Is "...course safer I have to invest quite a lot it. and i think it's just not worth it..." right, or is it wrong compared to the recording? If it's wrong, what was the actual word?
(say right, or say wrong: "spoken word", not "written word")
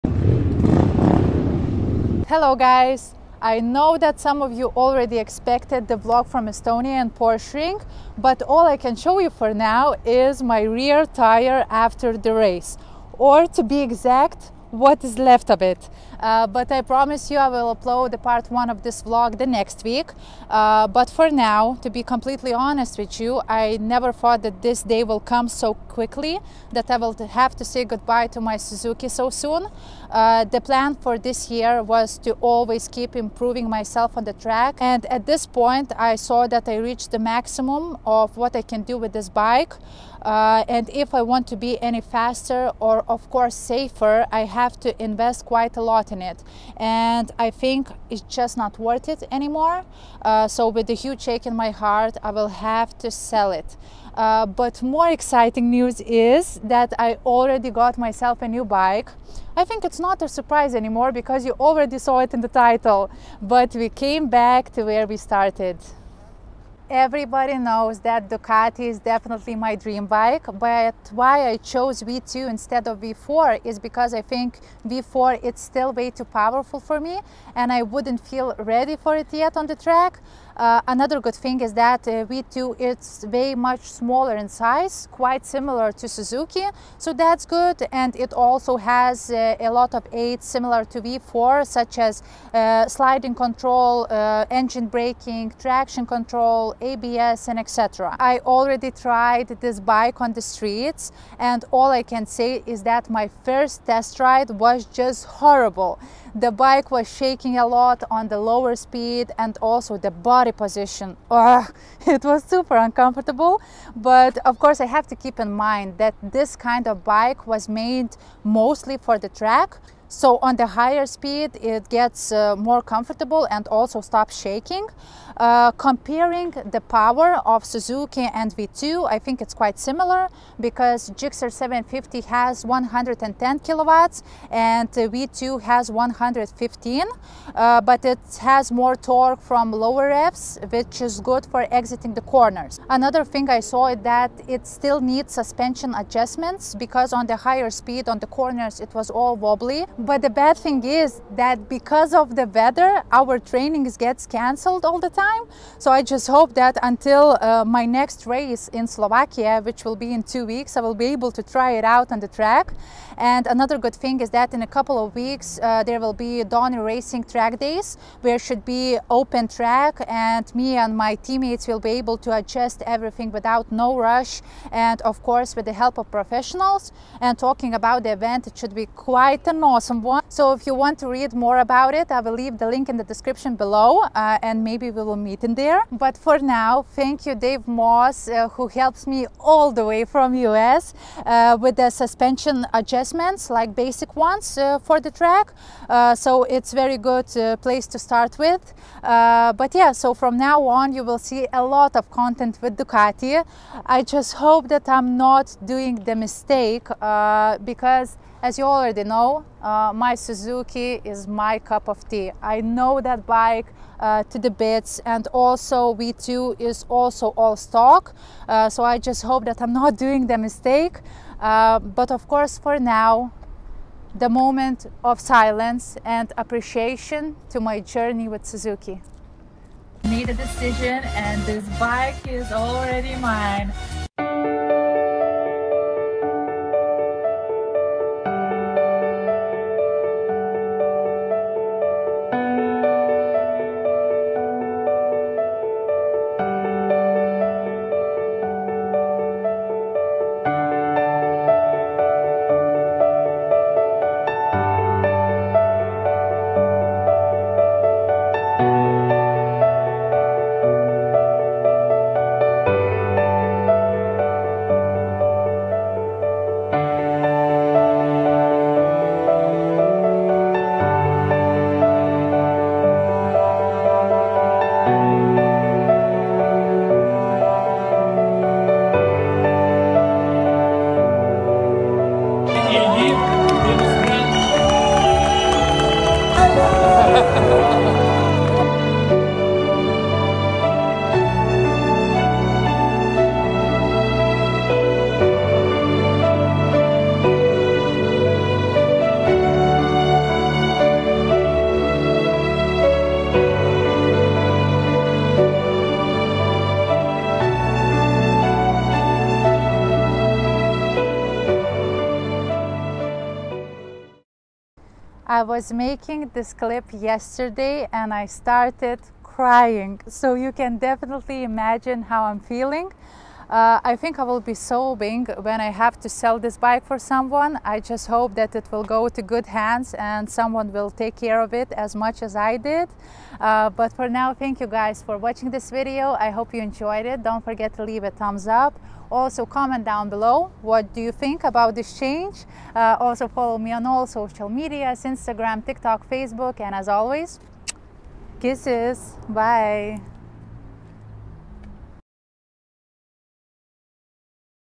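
right.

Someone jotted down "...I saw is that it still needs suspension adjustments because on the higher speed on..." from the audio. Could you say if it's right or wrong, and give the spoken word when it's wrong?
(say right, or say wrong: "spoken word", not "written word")
right.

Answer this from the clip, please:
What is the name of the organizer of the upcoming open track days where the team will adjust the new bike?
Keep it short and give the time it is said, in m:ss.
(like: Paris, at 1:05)
Donis Racing, at 2:46.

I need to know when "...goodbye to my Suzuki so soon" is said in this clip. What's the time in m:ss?
0:27.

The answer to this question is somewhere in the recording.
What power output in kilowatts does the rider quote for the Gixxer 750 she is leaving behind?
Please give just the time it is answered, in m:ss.
2:12.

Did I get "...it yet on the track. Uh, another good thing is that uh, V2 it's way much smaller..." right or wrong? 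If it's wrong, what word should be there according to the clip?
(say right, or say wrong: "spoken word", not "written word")
right.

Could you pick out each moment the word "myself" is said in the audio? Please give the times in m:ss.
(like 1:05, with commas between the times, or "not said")
0:33, 0:57.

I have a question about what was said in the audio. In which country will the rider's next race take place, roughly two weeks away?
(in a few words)
Slovakia.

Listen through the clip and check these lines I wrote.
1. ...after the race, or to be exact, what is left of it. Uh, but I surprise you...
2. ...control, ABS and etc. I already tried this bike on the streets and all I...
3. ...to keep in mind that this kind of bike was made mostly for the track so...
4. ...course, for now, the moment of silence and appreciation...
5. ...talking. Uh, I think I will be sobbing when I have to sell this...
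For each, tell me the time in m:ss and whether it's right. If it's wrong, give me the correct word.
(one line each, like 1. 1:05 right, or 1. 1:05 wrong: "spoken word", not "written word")
1. 0:11 wrong: "promise", not "surprise"
2. 1:36 right
3. 1:55 right
4. 3:42 right
5. 5:22 wrong: "feeling", not "talking".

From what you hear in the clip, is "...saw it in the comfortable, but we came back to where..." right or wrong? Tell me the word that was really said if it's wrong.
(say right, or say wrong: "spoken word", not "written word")
wrong: "title", not "comfortable".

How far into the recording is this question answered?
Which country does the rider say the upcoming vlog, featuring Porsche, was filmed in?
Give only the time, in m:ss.
0:06.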